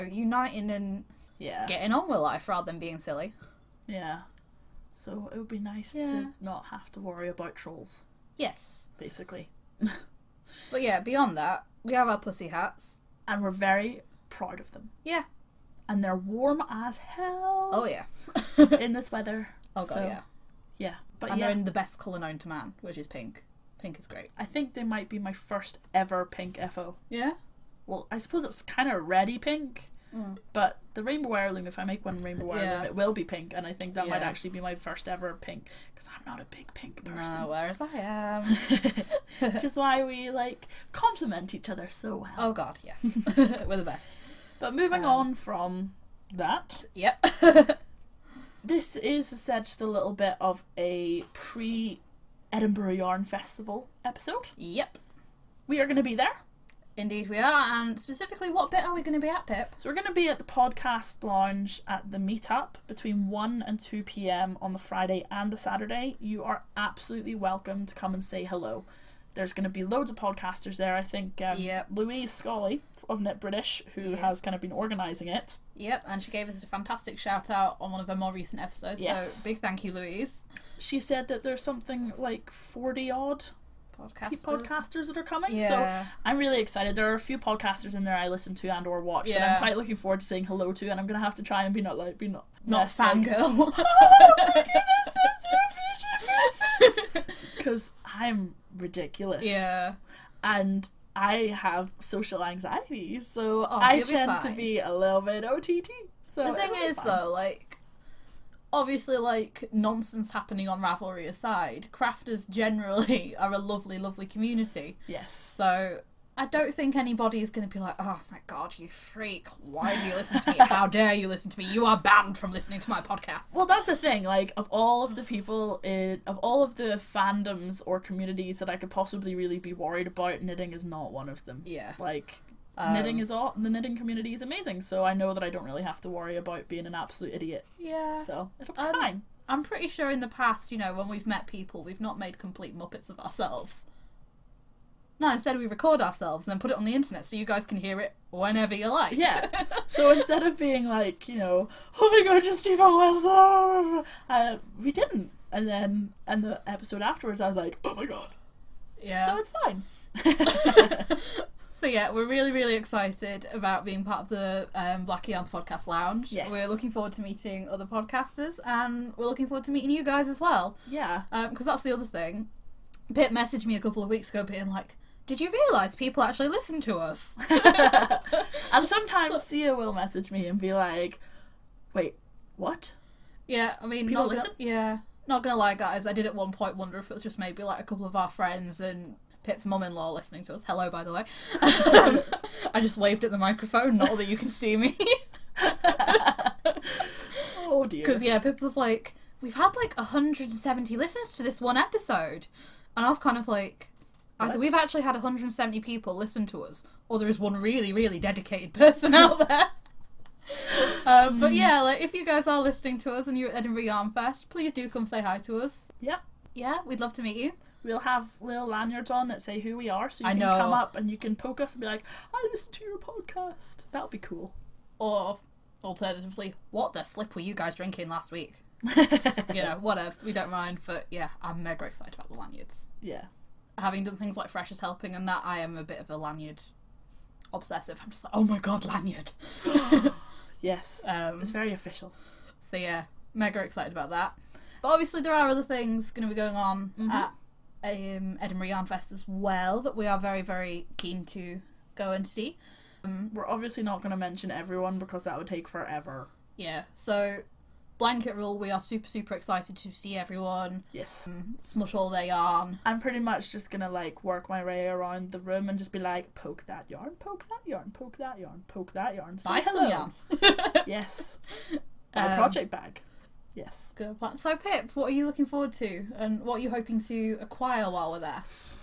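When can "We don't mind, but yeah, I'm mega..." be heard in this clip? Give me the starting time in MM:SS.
03:50.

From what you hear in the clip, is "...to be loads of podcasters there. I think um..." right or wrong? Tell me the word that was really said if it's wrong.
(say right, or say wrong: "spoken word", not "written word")
right.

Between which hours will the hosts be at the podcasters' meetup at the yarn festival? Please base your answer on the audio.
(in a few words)
1 and 2 pm.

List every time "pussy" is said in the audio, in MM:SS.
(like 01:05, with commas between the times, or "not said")
00:12.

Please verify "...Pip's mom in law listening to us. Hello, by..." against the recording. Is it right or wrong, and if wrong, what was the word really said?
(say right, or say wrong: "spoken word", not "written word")
right.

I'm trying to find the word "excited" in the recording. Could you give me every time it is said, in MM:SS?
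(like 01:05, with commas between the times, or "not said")
01:26, 02:42, 03:51, 04:03, 04:19.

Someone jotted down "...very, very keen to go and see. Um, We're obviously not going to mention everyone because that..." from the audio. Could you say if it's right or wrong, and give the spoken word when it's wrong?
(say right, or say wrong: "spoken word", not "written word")
right.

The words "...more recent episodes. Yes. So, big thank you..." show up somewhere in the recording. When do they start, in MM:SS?
01:18.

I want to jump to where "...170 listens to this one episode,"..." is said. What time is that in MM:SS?
03:19.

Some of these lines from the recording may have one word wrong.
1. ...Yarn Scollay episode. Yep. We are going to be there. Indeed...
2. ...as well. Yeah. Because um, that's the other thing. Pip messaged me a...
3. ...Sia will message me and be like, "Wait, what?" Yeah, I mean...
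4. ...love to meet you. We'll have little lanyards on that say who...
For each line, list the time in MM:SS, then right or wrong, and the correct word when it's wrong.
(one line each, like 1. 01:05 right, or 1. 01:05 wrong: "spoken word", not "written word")
1. 00:52 wrong: "Festival", not "Scollay"
2. 02:50 right
3. 02:59 right
4. 03:37 right.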